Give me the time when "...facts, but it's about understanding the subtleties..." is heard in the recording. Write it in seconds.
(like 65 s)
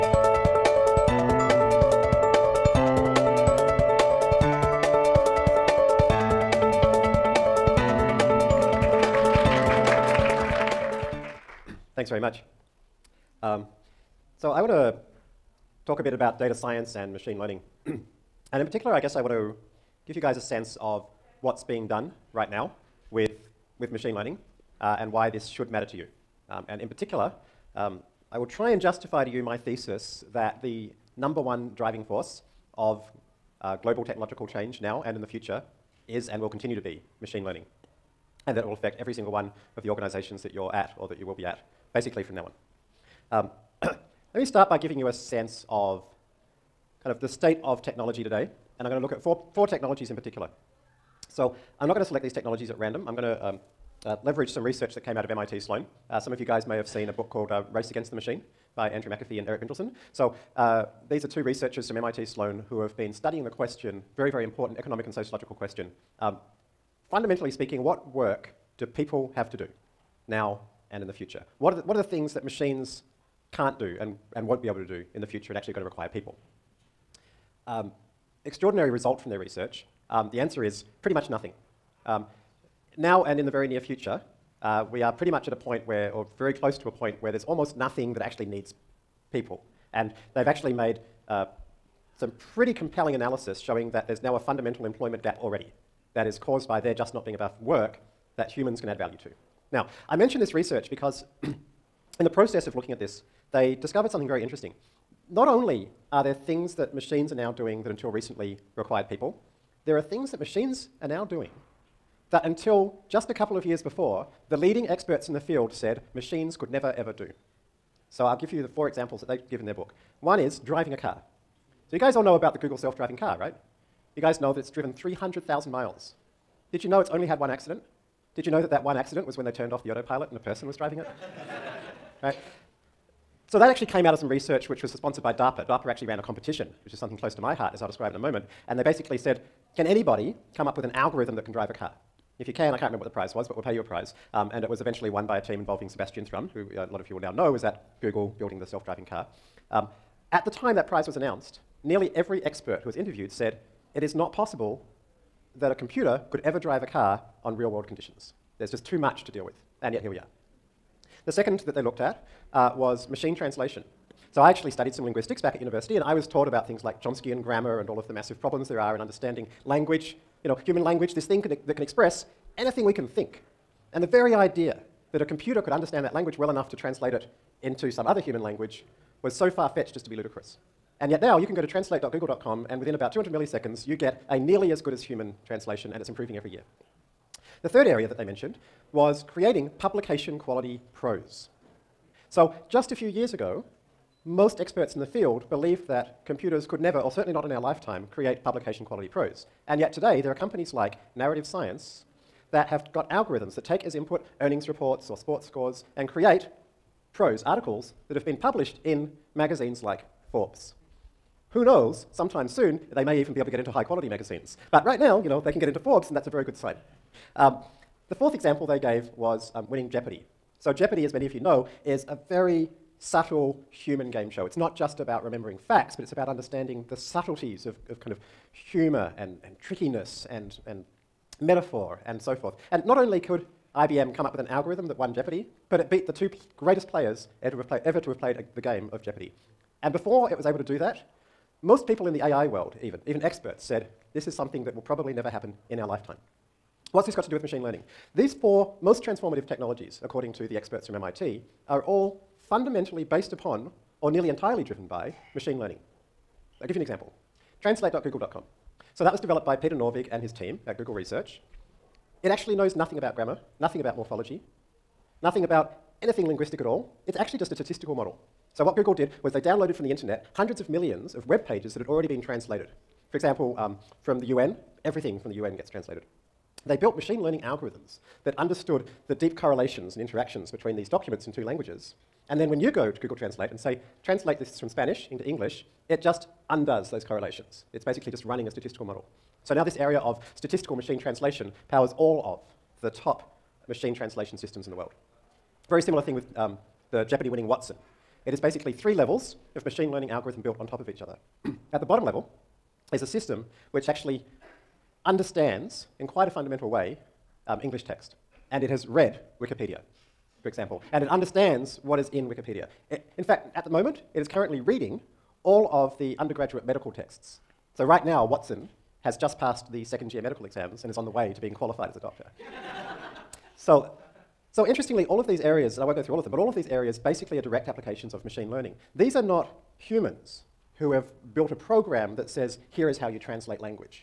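225 s.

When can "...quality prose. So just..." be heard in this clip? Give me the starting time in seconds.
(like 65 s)
190 s.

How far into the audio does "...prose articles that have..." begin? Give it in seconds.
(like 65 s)
207 s.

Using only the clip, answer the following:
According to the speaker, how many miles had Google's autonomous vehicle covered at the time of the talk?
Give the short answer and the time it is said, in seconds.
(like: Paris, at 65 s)
300,000, at 124 s.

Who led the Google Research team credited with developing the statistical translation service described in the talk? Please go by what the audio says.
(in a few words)
Peter Norvig.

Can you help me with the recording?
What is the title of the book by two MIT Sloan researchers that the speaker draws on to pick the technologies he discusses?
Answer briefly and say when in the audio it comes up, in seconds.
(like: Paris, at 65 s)
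Race Against the Machine, at 57 s.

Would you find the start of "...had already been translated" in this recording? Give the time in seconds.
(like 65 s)
271 s.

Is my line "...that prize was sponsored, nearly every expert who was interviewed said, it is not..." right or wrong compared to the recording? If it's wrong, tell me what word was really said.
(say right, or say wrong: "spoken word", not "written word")
wrong: "announced", not "sponsored".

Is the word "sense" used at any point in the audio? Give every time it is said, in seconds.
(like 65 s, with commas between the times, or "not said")
20 s, 45 s.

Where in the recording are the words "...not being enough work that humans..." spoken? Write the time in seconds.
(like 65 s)
97 s.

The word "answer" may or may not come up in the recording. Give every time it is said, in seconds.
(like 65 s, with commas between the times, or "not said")
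80 s.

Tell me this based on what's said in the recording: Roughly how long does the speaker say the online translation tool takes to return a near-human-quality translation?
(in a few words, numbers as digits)
200 milliseconds.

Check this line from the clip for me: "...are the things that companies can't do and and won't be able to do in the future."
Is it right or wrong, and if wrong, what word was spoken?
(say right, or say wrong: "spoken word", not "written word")
wrong: "machines", not "companies".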